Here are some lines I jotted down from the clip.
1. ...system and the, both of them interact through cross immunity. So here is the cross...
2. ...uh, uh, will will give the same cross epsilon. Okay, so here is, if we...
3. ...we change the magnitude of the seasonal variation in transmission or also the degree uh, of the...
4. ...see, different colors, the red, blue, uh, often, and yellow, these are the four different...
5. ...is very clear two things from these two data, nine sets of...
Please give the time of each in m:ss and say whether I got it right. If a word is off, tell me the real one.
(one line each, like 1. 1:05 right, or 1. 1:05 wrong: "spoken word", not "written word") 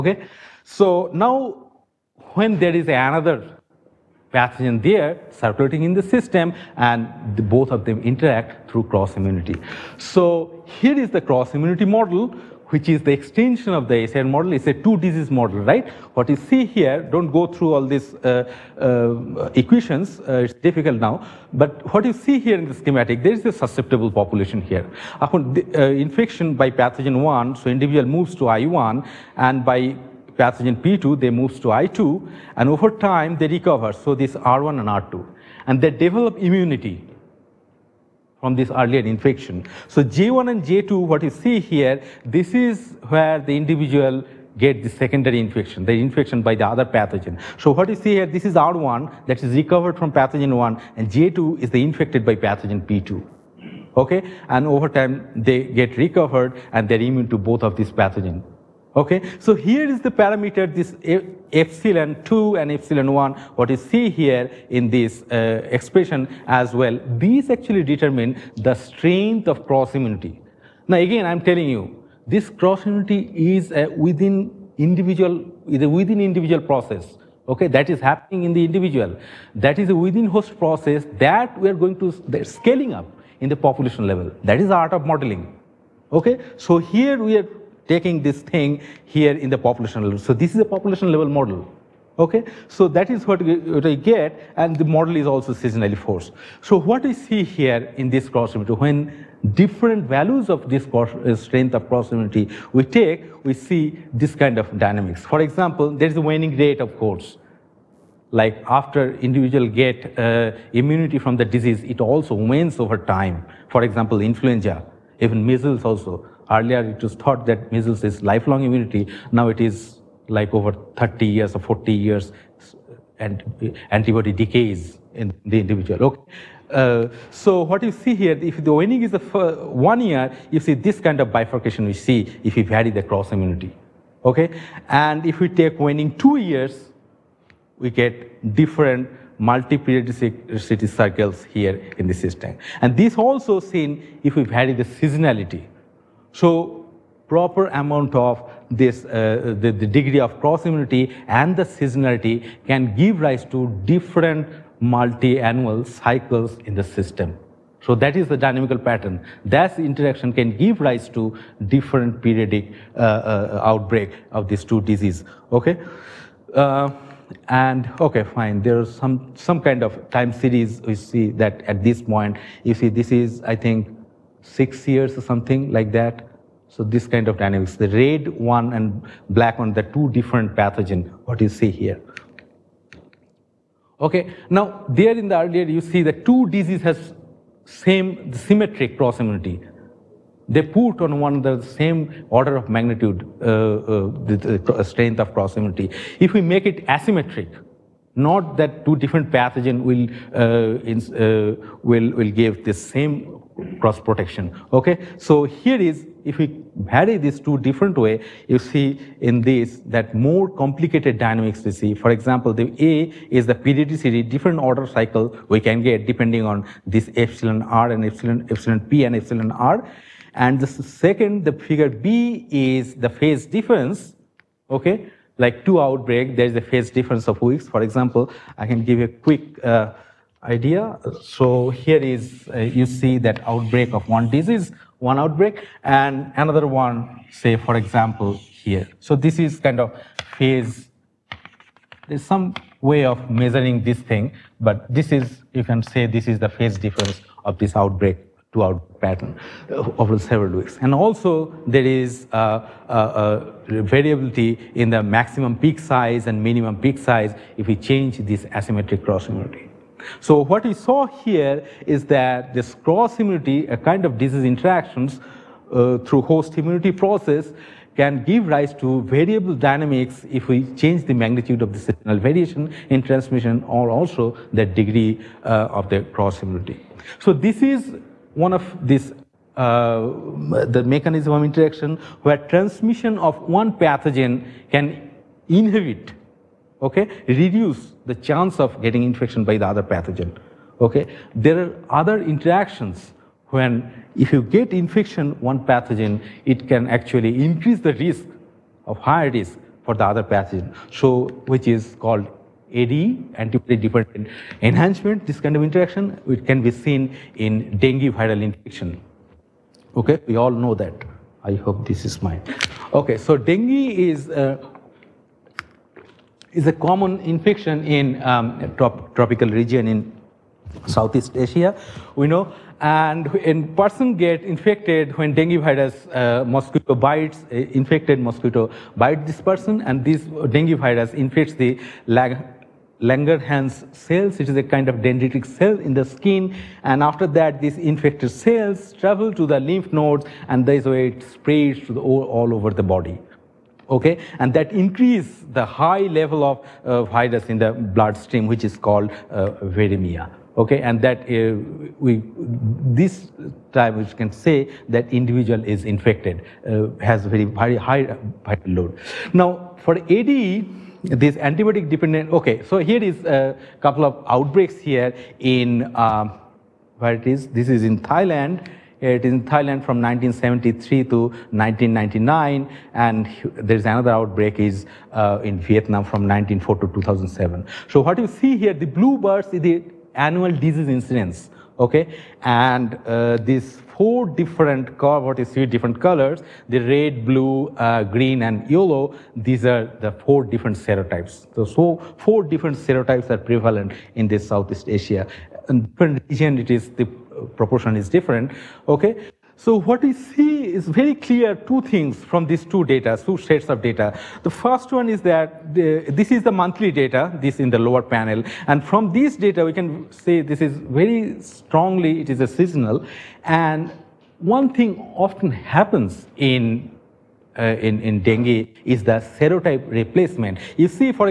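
1. 0:06 right
2. 3:20 wrong: "protection", not "epsilon"
3. 4:30 right
4. 6:25 wrong: "green", not "often"
5. 6:40 wrong: "two", not "nine".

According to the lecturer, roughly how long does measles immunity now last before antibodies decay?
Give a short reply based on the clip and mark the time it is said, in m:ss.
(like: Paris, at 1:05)
30 or 40 years, at 2:00.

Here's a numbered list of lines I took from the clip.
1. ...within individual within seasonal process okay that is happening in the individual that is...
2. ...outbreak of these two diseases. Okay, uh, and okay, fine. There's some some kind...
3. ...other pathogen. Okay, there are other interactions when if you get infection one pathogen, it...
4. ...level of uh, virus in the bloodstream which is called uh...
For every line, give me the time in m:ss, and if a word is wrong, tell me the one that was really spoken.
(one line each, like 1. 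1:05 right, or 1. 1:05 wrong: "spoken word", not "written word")
1. 1:14 wrong: "individual", not "seasonal"
2. 2:43 right
3. 4:49 right
4. 5:46 right.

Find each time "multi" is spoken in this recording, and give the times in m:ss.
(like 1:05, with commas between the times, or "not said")
2:19, 2:34.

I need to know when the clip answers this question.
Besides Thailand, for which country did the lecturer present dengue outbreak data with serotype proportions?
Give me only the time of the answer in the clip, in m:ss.
6:15.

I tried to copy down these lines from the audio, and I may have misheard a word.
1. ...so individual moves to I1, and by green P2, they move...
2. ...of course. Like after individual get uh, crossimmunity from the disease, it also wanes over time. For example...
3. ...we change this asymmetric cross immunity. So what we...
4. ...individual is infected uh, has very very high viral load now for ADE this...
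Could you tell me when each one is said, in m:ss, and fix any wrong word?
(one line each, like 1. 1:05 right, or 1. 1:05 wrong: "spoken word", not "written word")
1. 0:27 wrong: "pathogen", not "green"
2. 1:46 wrong: "immunity", not "crossimmunity"
3. 4:17 right
4. 5:55 right.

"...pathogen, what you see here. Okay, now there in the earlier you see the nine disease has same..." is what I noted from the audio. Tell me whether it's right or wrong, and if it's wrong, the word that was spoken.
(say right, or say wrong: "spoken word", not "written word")
wrong: "two", not "nine".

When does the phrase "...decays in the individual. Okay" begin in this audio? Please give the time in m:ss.
2:04.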